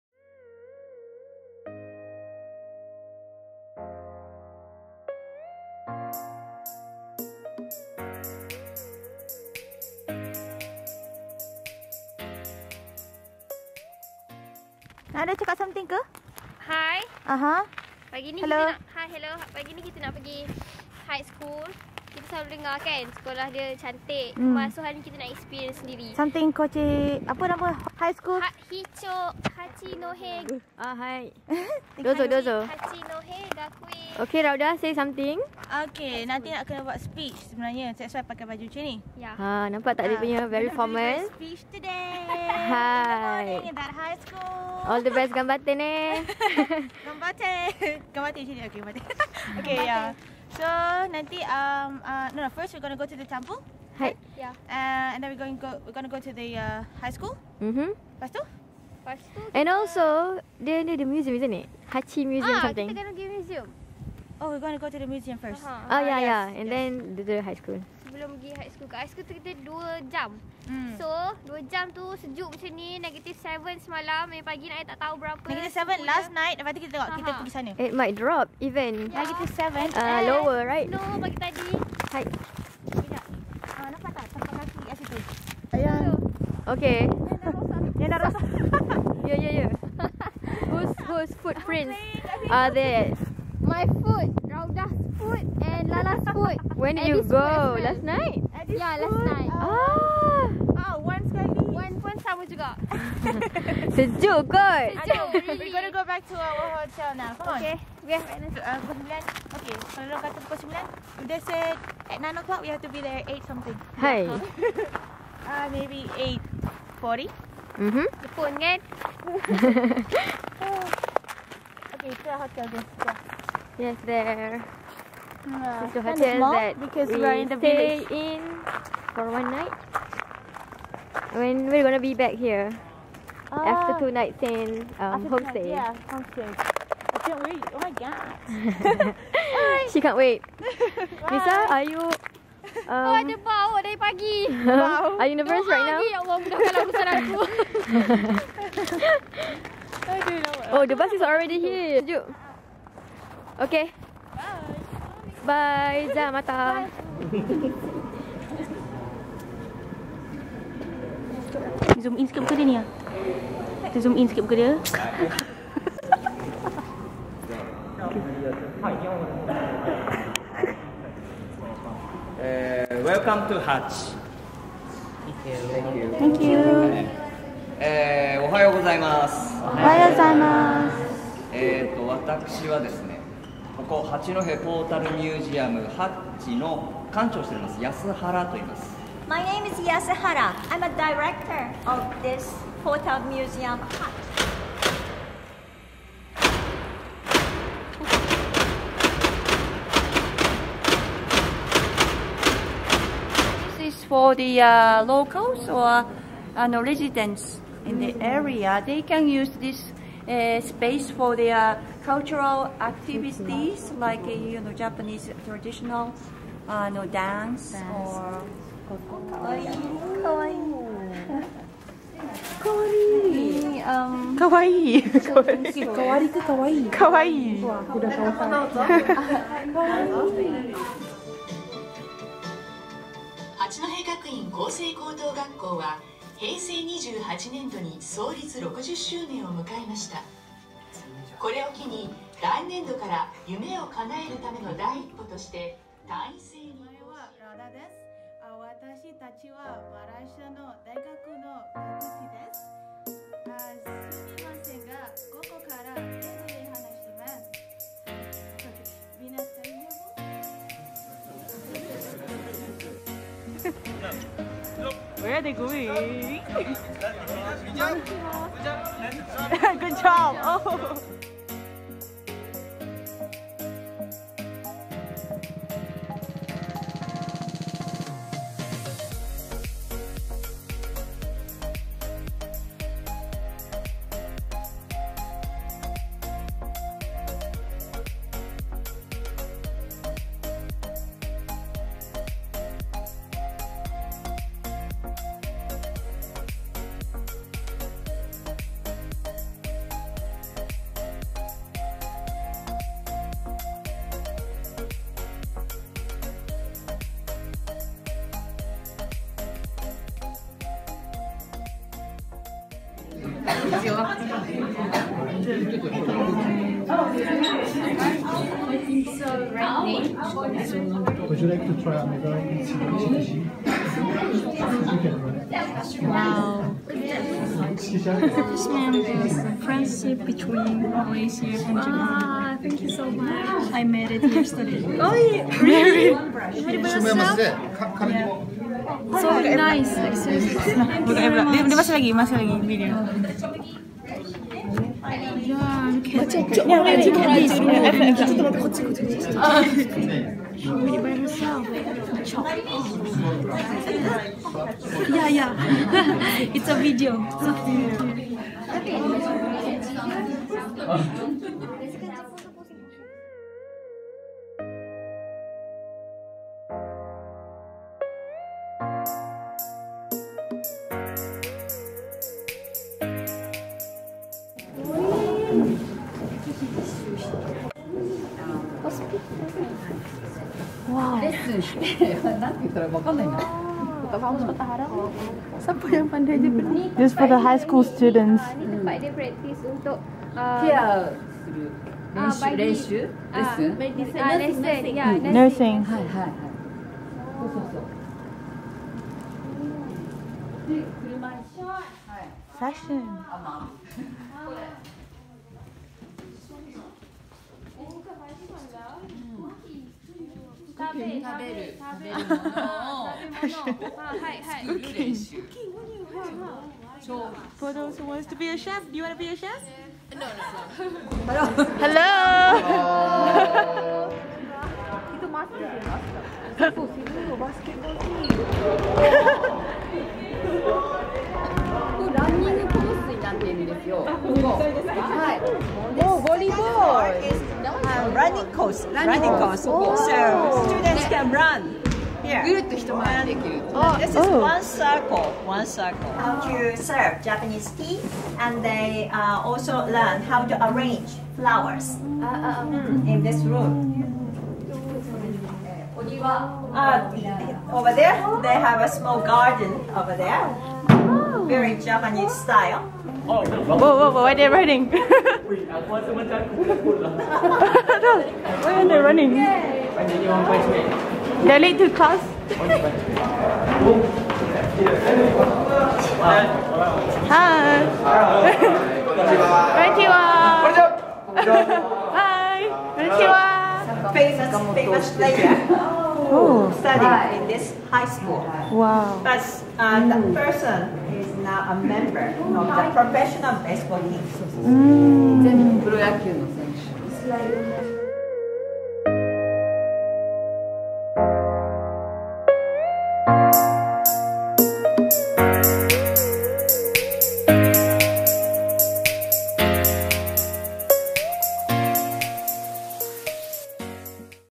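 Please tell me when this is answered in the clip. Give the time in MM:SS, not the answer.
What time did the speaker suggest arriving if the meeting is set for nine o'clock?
01:55.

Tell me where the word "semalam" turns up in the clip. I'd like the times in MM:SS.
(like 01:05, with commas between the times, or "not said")
01:13.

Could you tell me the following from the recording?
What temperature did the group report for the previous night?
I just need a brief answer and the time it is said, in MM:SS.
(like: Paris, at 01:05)
-7, at 01:15.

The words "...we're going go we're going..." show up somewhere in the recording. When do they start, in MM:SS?
00:55.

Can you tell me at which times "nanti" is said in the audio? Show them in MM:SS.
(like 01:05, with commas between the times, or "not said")
00:36, 00:51.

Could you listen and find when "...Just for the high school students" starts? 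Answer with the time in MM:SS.
06:26.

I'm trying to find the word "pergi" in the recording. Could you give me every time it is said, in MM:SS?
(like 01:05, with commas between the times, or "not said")
00:20, 01:03, 01:08, 01:17.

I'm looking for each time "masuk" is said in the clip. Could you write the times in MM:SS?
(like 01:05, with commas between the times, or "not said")
00:24, 05:41.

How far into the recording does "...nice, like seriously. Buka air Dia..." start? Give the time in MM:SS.
05:39.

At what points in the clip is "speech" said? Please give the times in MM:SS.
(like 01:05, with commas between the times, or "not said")
00:36, 00:41.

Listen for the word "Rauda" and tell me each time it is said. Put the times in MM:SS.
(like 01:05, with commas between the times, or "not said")
00:34, 01:34.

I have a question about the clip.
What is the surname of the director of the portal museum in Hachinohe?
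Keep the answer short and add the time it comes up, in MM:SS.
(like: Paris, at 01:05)
Yasuhara, at 03:09.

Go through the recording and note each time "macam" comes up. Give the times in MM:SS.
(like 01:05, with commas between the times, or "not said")
00:38, 01:12, 07:46.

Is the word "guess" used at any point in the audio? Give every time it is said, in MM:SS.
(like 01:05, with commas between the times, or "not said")
not said.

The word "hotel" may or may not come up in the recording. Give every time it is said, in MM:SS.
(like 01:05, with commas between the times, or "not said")
01:46, 02:06.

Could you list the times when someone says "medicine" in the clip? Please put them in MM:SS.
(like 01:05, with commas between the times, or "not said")
06:32.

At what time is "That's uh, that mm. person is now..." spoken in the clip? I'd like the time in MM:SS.
08:09.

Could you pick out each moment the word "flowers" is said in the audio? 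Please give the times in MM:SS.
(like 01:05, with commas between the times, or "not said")
07:31.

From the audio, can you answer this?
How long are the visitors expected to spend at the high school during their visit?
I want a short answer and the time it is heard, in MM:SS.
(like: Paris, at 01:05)
2 hours, at 01:08.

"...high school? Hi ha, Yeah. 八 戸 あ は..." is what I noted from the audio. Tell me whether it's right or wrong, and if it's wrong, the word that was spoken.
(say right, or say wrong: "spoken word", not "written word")
wrong: "Hicok", not "Yeah".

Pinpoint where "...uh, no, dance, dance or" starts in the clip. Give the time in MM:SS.
03:36.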